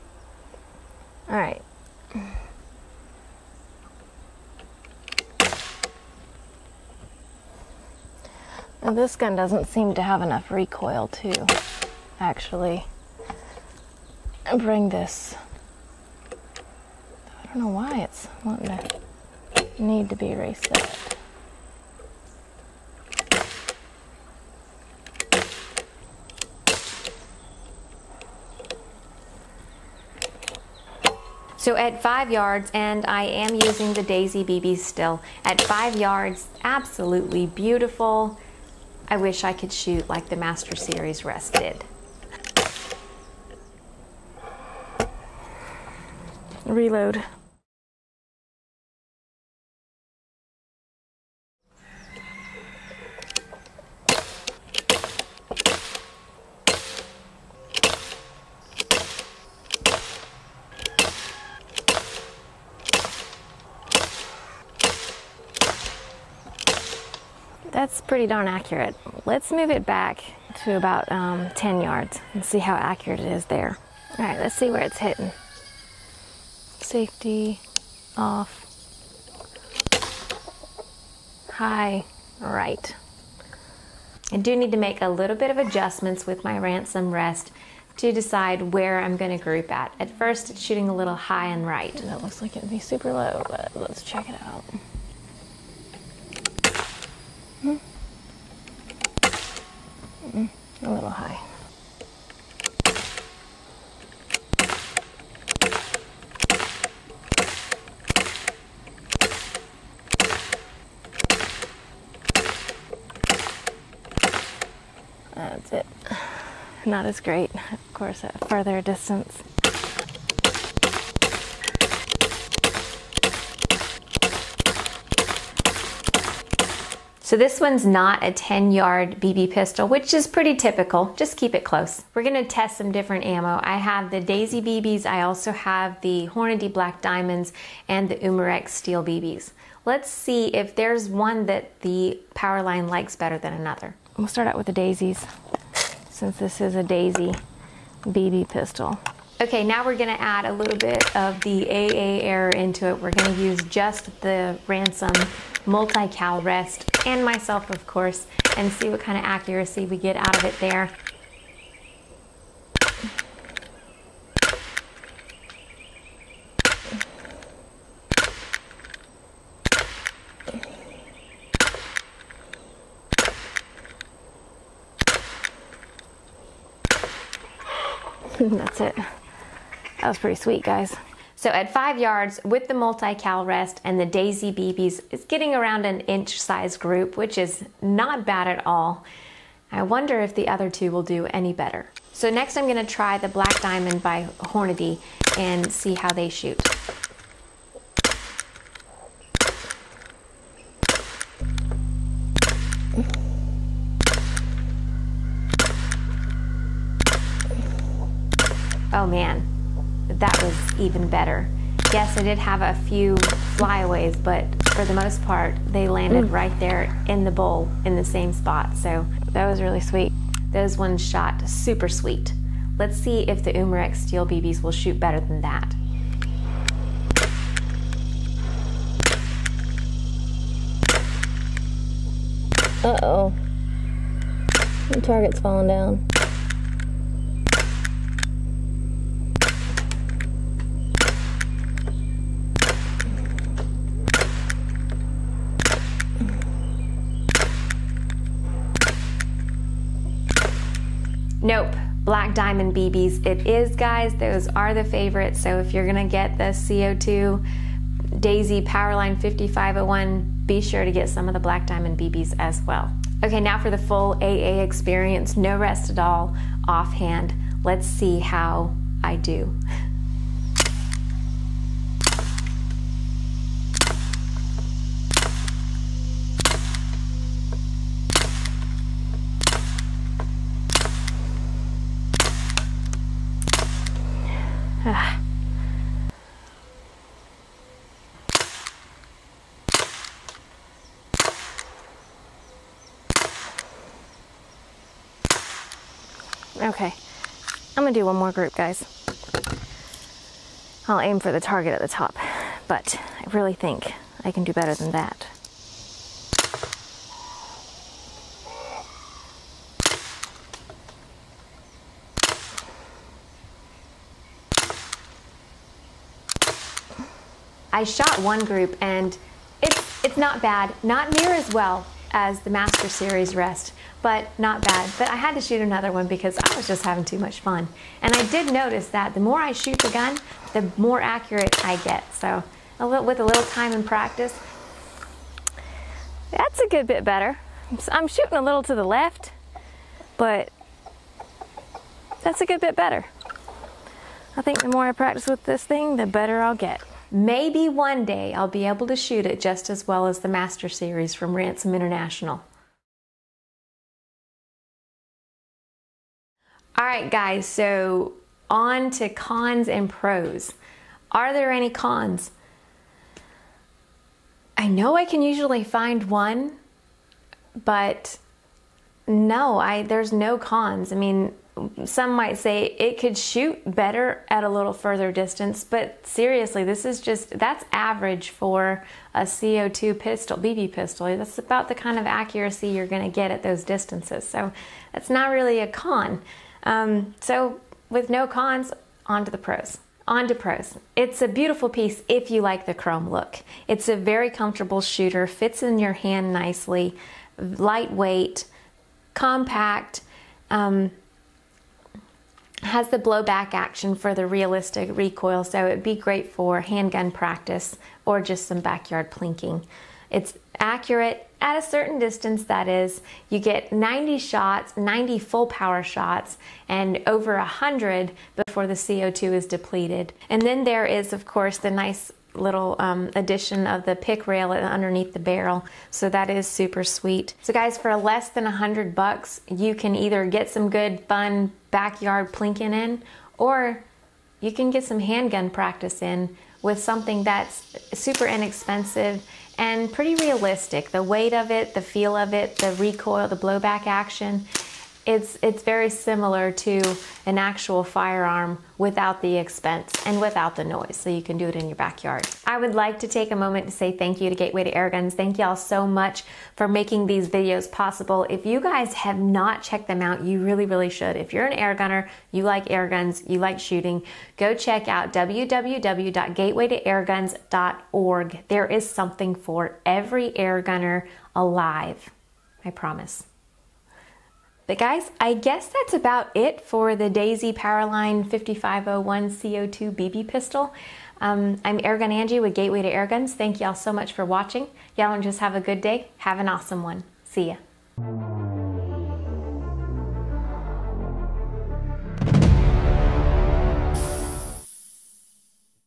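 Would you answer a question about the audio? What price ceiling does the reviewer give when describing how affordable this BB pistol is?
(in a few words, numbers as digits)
Less than $100.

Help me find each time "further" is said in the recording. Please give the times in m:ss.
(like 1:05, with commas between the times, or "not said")
1:58, 6:14.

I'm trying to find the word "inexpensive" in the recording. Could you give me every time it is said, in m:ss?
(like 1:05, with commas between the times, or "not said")
7:18.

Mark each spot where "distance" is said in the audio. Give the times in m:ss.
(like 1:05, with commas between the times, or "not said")
1:58, 6:15, 6:23, 6:51.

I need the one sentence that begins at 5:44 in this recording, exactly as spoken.
I think the more I practice with this thing, the better I'll get.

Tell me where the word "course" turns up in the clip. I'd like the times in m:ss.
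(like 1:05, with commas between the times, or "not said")
1:57, 2:37, 7:01.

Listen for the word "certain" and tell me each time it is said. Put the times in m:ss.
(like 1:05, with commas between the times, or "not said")
6:51.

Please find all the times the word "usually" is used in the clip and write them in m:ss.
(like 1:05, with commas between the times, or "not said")
6:05.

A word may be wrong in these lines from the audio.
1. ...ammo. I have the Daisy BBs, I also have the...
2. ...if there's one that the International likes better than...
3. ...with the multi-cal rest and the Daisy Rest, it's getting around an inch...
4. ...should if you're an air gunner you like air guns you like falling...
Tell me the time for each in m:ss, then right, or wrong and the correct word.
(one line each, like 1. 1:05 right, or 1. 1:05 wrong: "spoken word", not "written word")
1. 2:13 right
2. 2:20 wrong: "Powerline", not "International"
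3. 3:02 wrong: "BBs", not "Rest"
4. 7:40 wrong: "shooting", not "falling".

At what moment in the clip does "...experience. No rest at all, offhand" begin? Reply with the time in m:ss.
4:24.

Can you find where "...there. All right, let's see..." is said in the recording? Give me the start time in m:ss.
1:13.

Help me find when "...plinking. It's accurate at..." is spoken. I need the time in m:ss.
6:49.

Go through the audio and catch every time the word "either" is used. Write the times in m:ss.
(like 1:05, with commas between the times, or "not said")
7:09.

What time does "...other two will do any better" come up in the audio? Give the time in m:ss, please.
3:10.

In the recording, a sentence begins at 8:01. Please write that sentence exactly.
Um, I'm Airgun Angie with Gateway to Airguns.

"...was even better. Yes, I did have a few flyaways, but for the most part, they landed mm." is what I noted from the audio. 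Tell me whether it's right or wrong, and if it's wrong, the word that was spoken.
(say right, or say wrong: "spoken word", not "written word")
right.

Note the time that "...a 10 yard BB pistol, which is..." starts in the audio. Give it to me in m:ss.
2:08.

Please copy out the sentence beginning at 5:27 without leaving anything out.
And I did notice that the more I shoot the gun, the more accurate I get.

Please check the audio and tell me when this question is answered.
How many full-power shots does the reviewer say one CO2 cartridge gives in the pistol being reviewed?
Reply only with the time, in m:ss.
6:54.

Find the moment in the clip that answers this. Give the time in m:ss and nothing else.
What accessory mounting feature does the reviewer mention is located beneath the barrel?
7:03.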